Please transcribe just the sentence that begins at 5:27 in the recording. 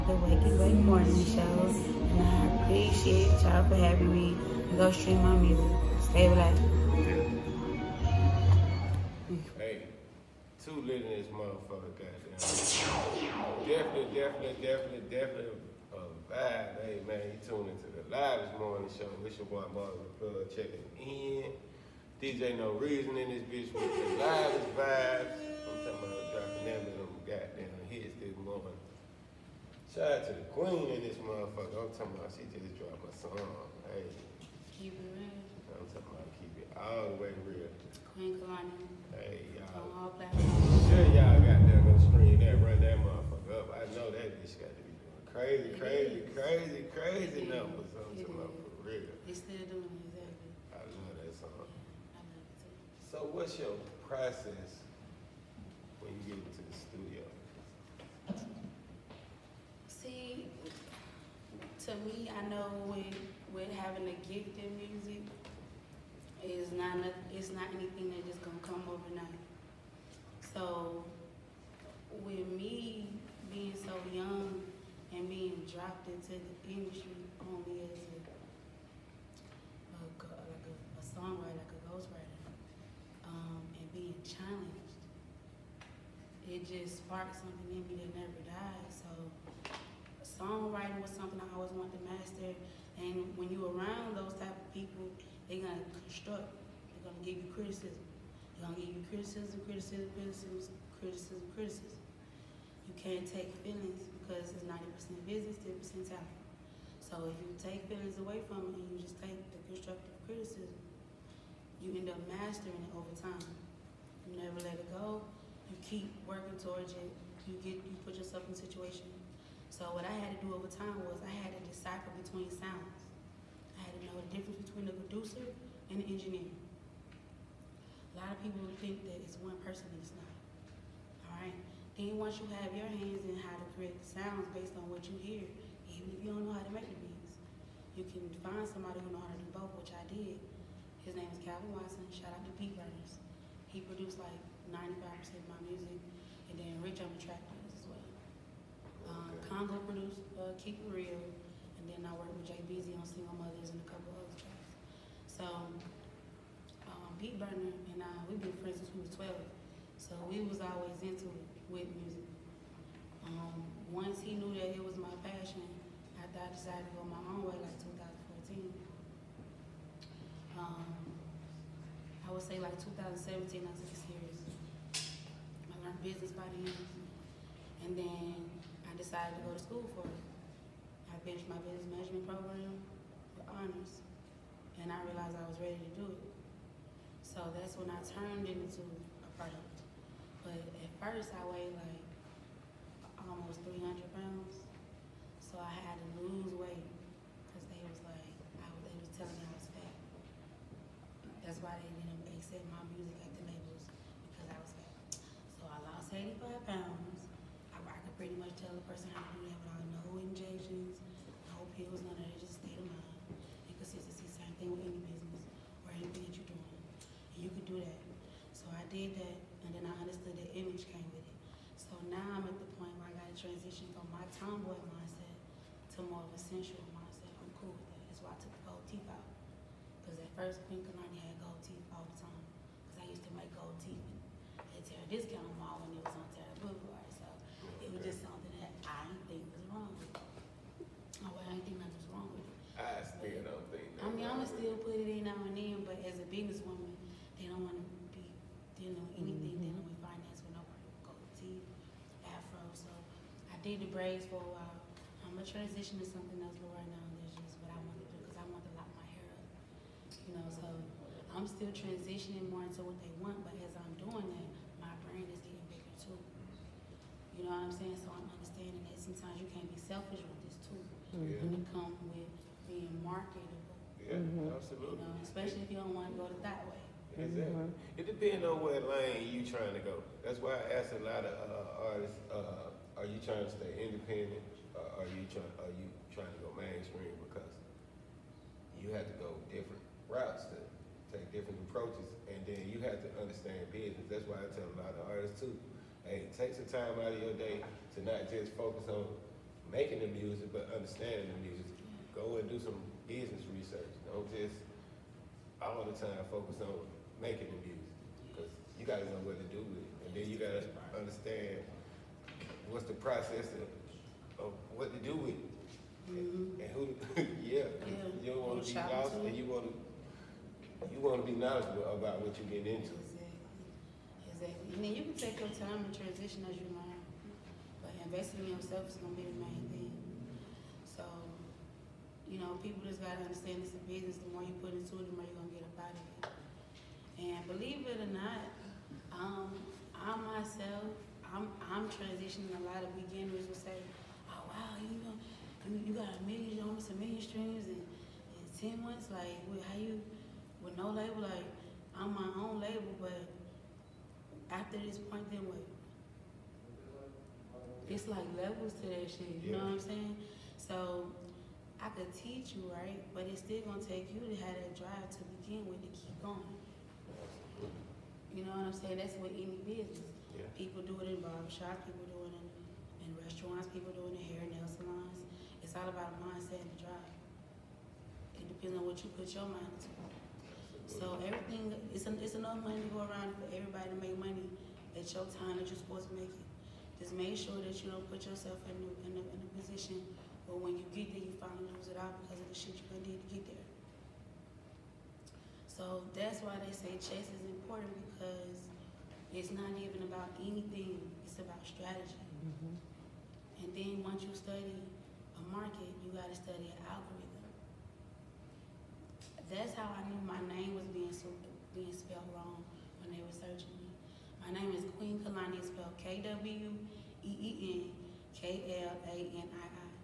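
But investing in yourself is going to be the main thing.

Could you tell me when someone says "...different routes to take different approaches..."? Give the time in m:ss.
4:49.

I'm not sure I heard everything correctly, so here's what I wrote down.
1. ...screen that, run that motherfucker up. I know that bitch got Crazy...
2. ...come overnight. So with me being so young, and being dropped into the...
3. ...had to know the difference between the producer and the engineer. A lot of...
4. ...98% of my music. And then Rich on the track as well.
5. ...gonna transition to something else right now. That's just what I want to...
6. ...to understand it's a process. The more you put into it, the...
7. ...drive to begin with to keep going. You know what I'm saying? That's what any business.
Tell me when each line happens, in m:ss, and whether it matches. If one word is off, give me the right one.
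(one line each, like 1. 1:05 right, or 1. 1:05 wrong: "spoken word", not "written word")
1. 0:42 right
2. 1:08 right
3. 2:03 right
4. 2:24 wrong: "95", not "98"
5. 4:15 right
6. 5:33 wrong: "business", not "process"
7. 6:04 right.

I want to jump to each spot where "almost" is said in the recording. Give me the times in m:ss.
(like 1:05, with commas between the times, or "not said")
3:13, 5:46.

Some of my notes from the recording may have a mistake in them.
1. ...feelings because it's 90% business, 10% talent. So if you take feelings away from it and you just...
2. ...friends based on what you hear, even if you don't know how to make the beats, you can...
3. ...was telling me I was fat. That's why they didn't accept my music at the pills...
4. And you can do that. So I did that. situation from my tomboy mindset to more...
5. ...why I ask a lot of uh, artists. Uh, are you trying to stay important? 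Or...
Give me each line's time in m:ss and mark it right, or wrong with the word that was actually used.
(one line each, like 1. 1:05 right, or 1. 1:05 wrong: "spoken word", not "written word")
1. 1:43 right
2. 2:13 wrong: "sounds", not "friends"
3. 3:18 wrong: "labels", not "pills"
4. 3:37 wrong: "transition", not "situation"
5. 4:40 wrong: "independent", not "important".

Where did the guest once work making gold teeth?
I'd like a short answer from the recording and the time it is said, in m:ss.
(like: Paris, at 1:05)
Terra Discount Mall, at 3:54.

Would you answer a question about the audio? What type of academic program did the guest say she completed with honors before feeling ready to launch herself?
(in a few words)
business management.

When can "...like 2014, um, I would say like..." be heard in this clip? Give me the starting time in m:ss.
2:47.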